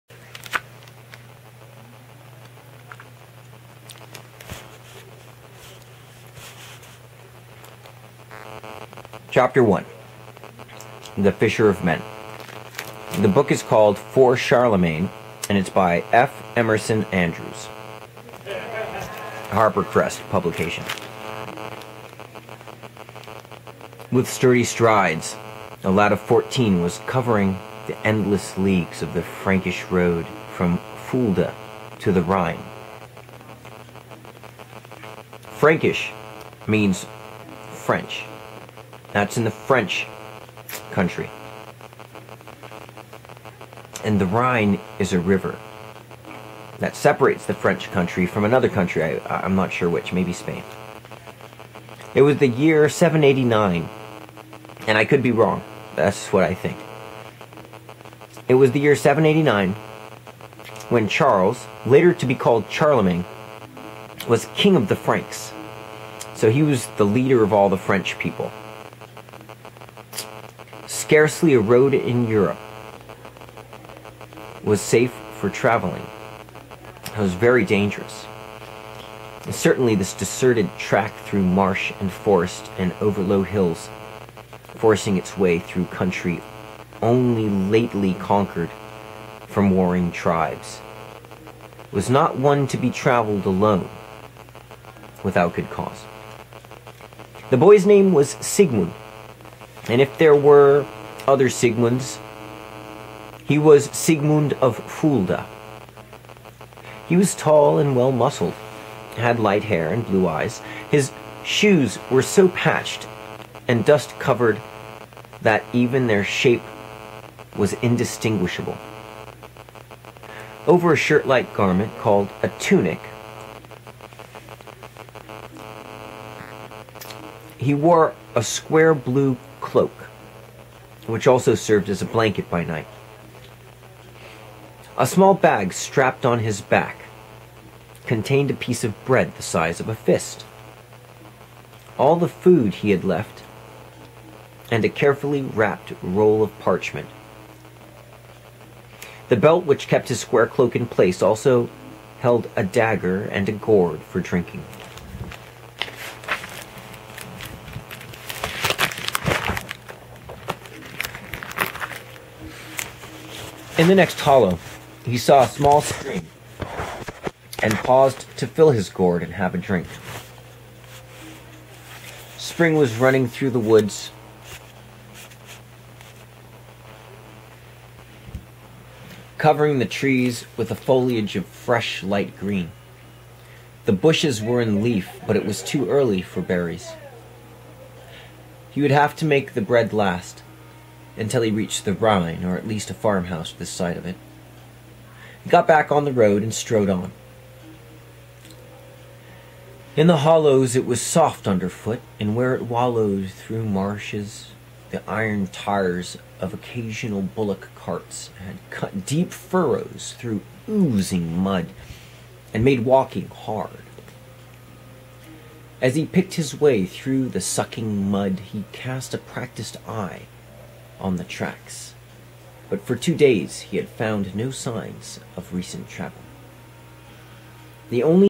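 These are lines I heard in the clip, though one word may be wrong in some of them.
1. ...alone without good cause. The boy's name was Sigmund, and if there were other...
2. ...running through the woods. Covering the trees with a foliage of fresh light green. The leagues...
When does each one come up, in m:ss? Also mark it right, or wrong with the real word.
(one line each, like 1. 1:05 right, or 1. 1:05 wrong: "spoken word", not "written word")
1. 1:33 right
2. 2:52 wrong: "bushes", not "leagues".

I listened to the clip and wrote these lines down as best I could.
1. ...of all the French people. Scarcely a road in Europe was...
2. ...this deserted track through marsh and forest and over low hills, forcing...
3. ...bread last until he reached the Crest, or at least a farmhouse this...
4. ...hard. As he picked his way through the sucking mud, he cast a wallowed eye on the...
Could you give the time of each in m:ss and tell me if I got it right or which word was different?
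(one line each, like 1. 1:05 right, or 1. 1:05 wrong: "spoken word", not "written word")
1. 1:07 right
2. 1:19 right
3. 3:09 wrong: "Rhine", not "Crest"
4. 3:33 wrong: "practiced", not "wallowed".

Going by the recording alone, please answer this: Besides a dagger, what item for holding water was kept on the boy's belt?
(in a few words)
A gourd.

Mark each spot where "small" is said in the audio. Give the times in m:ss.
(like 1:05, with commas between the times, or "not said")
2:15, 2:45.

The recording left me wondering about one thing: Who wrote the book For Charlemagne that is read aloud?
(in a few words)
F. Emerson Andrews.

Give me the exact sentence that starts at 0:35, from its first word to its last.
Frankish means French that's in the French country.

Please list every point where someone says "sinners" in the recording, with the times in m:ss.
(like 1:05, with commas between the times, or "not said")
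not said.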